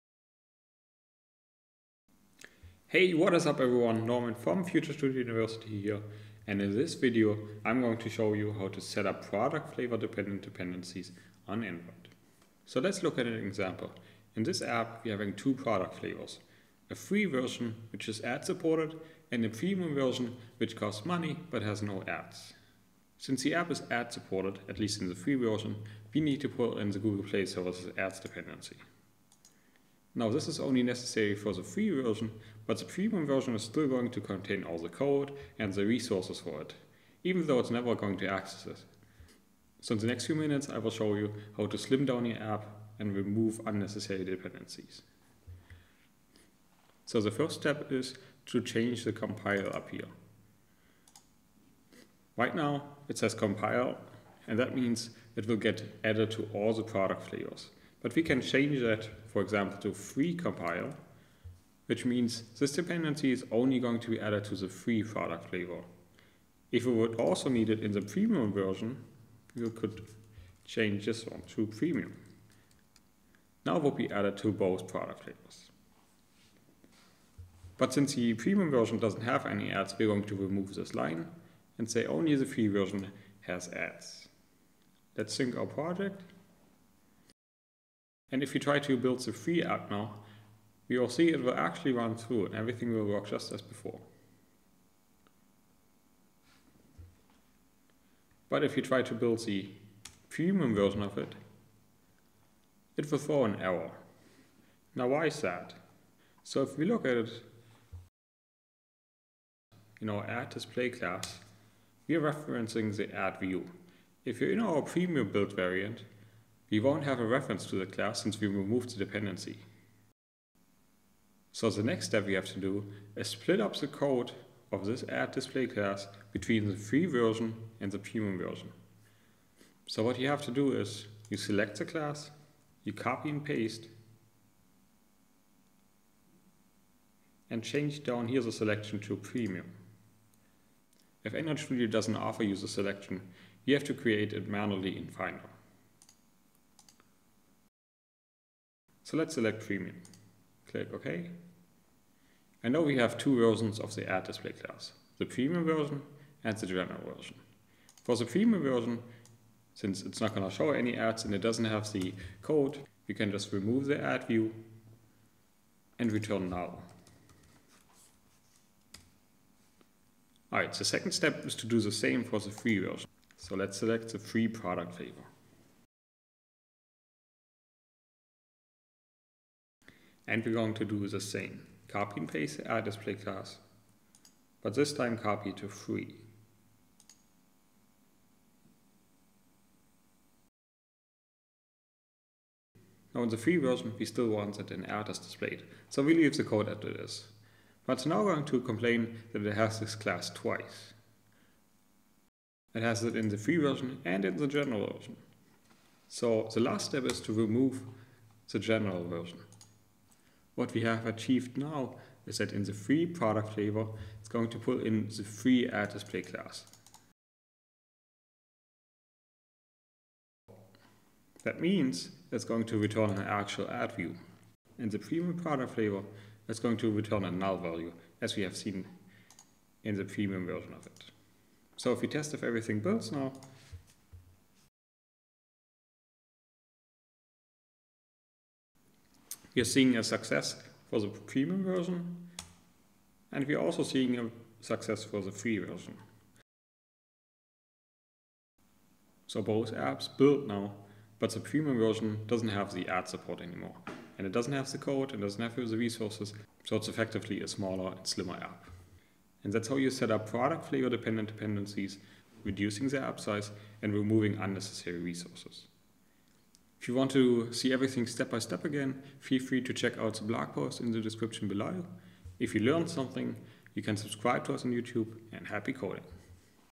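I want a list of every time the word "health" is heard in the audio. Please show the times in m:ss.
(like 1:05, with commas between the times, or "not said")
not said.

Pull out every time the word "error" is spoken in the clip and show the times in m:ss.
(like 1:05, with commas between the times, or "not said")
1:43, 3:14.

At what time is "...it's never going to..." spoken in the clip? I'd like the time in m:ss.
0:37.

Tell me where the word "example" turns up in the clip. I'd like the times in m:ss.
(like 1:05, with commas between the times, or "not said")
0:13, 0:59.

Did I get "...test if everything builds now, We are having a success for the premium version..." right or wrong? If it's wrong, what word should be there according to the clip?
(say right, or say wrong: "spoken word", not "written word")
wrong: "seeing", not "having".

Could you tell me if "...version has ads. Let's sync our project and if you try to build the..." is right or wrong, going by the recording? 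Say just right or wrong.
right.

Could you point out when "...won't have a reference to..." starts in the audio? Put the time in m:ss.
1:56.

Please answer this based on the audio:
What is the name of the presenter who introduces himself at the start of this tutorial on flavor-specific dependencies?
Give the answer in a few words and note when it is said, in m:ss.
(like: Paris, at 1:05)
Norman, at 0:04.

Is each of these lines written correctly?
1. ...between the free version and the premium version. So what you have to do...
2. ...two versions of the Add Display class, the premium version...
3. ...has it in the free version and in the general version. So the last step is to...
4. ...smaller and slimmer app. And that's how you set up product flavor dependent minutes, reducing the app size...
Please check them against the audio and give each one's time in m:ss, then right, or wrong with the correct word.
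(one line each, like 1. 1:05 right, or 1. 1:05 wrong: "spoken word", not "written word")
1. 2:06 right
2. 2:33 right
3. 3:22 right
4. 4:17 wrong: "dependencies", not "minutes".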